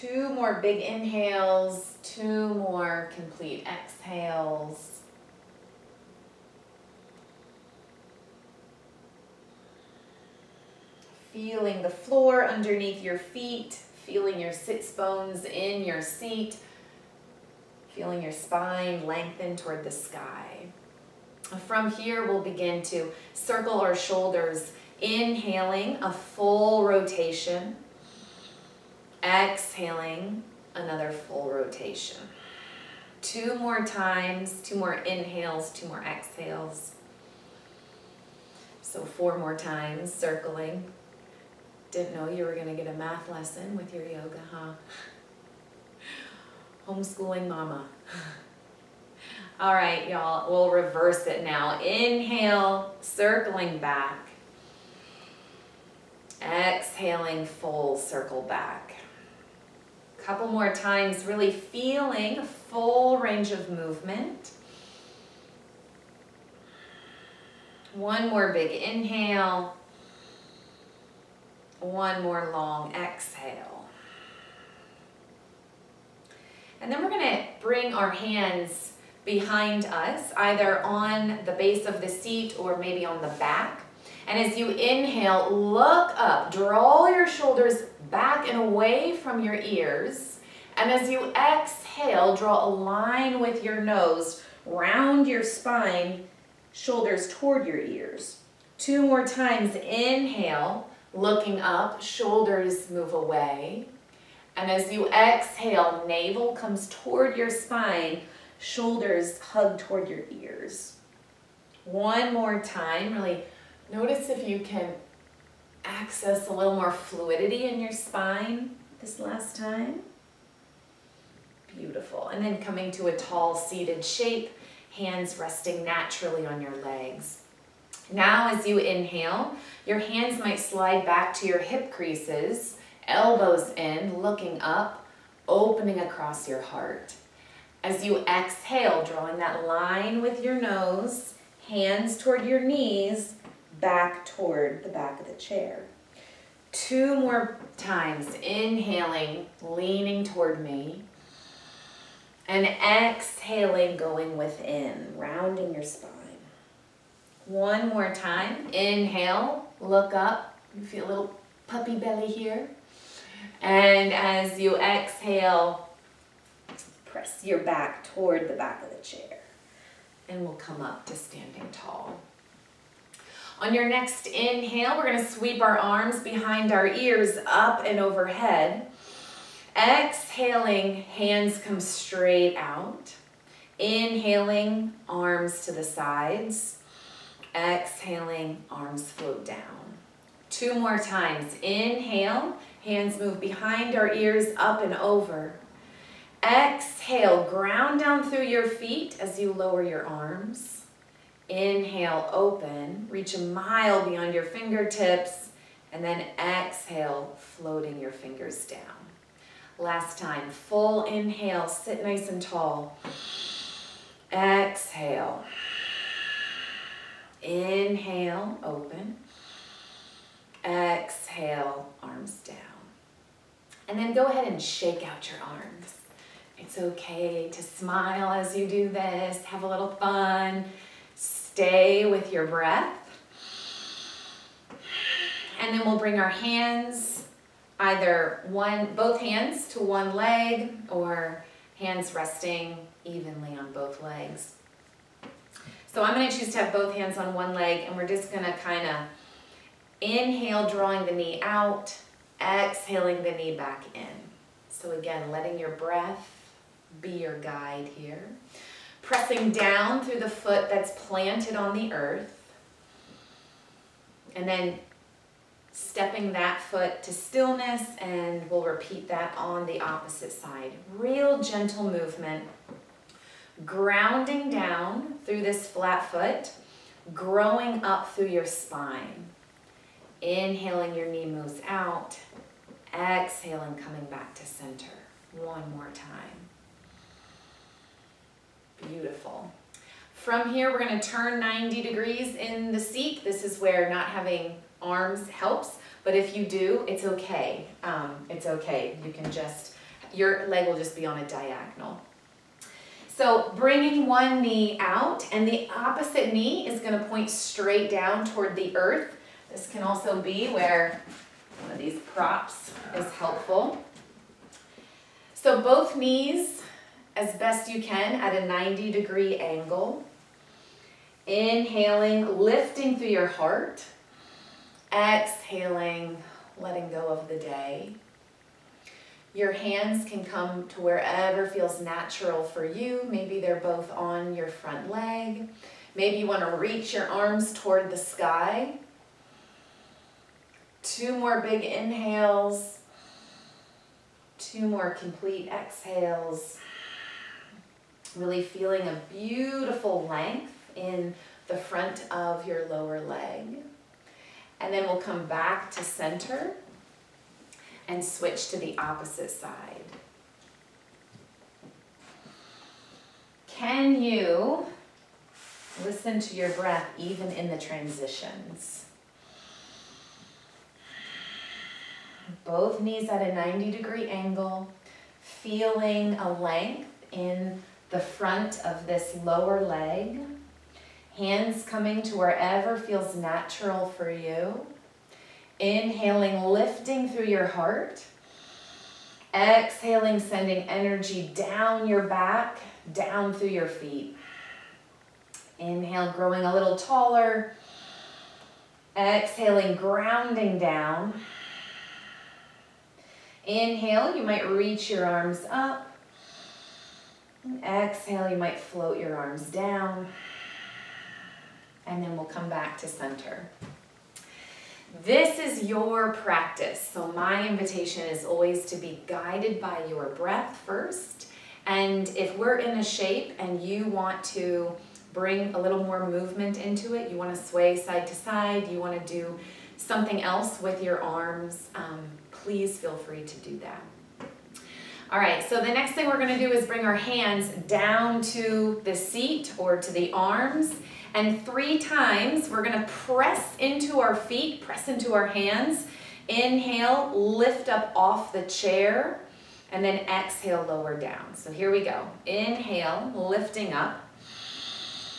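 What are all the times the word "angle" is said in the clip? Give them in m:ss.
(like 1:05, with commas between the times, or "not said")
5:19, 6:14.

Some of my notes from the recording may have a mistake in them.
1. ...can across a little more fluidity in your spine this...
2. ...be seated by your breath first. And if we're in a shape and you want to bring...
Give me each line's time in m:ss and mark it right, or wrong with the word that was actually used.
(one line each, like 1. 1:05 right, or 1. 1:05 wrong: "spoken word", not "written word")
1. 1:54 wrong: "access", not "across"
2. 6:58 wrong: "guided", not "seated".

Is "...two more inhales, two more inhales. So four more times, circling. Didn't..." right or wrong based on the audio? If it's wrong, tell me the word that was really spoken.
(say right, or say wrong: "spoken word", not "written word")
wrong: "exhales", not "inhales".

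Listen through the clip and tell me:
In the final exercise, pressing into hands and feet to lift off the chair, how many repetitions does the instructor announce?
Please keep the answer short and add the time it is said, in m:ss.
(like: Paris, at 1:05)
3, at 7:21.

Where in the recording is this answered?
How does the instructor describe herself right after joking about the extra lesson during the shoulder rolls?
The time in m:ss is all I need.
0:46.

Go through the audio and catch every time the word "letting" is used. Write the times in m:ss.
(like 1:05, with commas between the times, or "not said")
4:15, 5:26.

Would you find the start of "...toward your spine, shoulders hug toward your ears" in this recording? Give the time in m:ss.
1:46.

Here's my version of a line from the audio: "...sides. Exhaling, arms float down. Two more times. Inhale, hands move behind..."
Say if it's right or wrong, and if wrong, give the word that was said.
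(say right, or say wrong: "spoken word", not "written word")
right.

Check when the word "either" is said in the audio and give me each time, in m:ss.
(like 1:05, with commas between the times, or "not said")
1:20, 3:57.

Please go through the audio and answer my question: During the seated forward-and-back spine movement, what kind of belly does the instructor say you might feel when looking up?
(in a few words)
puppy belly.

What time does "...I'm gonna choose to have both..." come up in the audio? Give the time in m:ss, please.
4:06.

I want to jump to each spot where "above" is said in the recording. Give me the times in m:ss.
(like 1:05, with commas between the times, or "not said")
not said.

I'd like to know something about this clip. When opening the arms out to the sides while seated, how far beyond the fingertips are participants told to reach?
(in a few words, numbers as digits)
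a mile.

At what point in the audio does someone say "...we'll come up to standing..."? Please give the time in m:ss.
2:50.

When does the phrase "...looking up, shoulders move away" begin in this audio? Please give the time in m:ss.
1:41.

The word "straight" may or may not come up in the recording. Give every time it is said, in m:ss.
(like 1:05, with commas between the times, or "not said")
3:01, 5:07.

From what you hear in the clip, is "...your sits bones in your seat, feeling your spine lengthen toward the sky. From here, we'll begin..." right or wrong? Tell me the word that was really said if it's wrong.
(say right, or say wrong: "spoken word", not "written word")
right.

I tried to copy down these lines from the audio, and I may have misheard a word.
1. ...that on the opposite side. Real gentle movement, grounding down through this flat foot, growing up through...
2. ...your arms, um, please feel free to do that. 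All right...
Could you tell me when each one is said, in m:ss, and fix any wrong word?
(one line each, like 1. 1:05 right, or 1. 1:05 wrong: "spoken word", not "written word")
1. 4:29 right
2. 7:10 right.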